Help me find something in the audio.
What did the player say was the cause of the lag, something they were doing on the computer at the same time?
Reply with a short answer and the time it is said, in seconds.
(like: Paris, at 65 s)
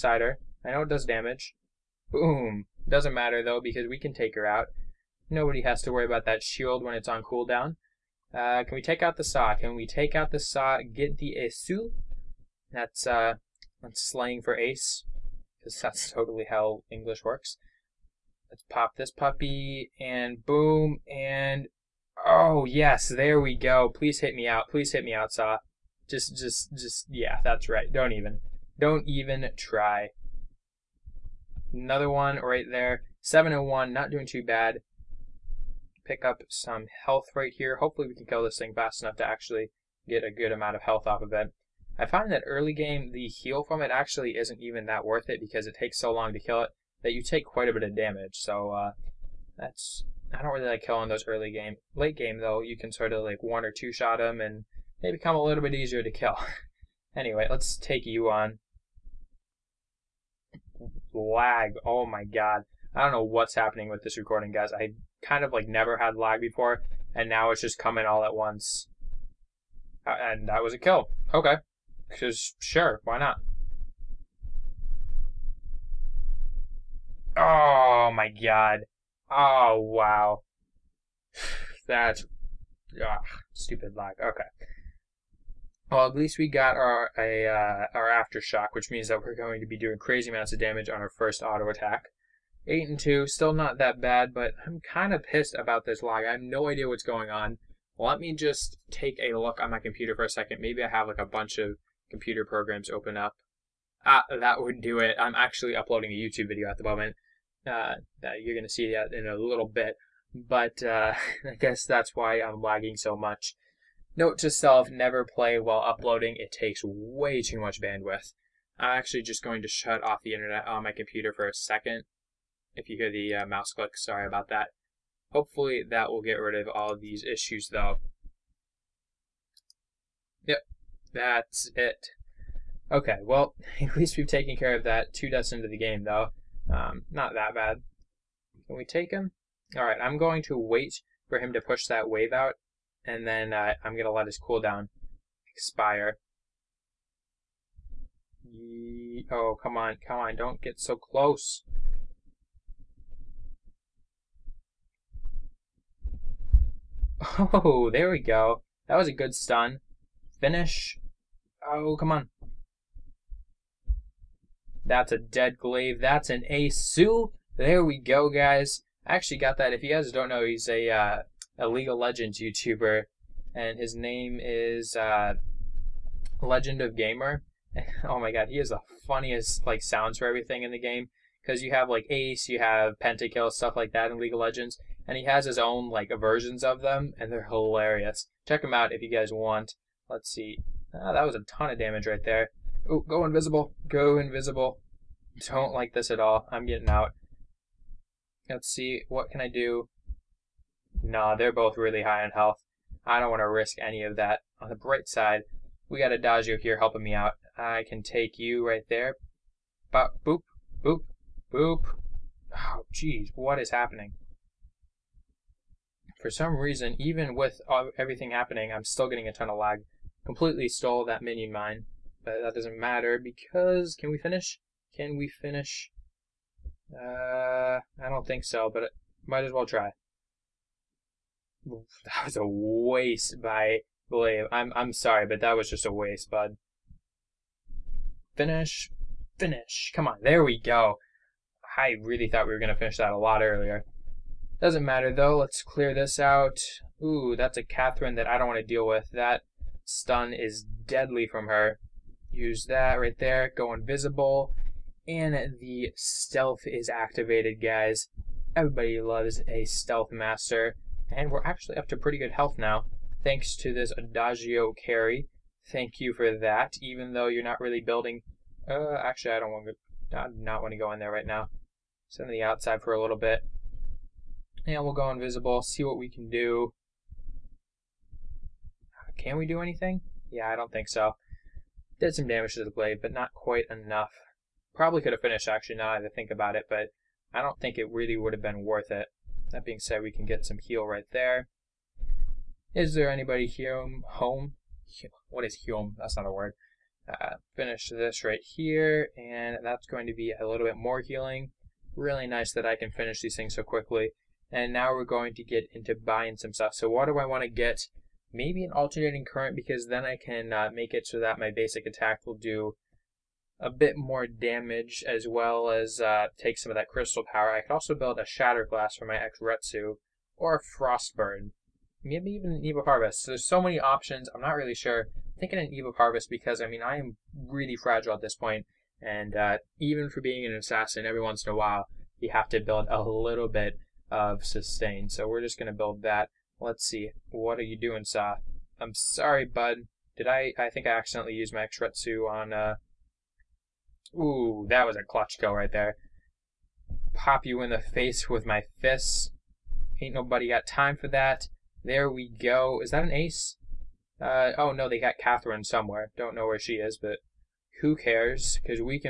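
Uploading a YouTube video, at 105 s.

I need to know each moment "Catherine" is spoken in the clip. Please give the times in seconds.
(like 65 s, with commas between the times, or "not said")
247 s, 355 s.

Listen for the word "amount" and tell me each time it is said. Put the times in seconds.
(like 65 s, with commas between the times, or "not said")
40 s, 90 s.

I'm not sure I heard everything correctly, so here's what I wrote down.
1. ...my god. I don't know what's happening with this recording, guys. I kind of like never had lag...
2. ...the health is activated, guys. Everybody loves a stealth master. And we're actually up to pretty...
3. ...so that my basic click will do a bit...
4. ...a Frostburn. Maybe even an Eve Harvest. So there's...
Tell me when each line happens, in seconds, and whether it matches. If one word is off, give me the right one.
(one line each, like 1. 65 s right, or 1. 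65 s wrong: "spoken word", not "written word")
1. 62 s right
2. 255 s wrong: "stealth", not "health"
3. 311 s wrong: "attack", not "click"
4. 320 s right.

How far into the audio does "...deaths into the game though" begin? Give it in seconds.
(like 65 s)
135 s.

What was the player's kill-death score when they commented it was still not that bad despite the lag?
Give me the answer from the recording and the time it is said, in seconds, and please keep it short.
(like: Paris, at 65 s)
8 and 2, at 92 s.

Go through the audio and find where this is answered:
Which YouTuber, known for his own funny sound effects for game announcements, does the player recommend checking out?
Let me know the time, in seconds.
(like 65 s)
176 s.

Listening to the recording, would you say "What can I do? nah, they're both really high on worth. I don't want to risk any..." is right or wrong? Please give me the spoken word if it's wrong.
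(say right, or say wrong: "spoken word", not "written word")
wrong: "health", not "worth".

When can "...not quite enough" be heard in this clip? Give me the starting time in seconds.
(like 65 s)
283 s.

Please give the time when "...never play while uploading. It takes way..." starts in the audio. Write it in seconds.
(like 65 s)
114 s.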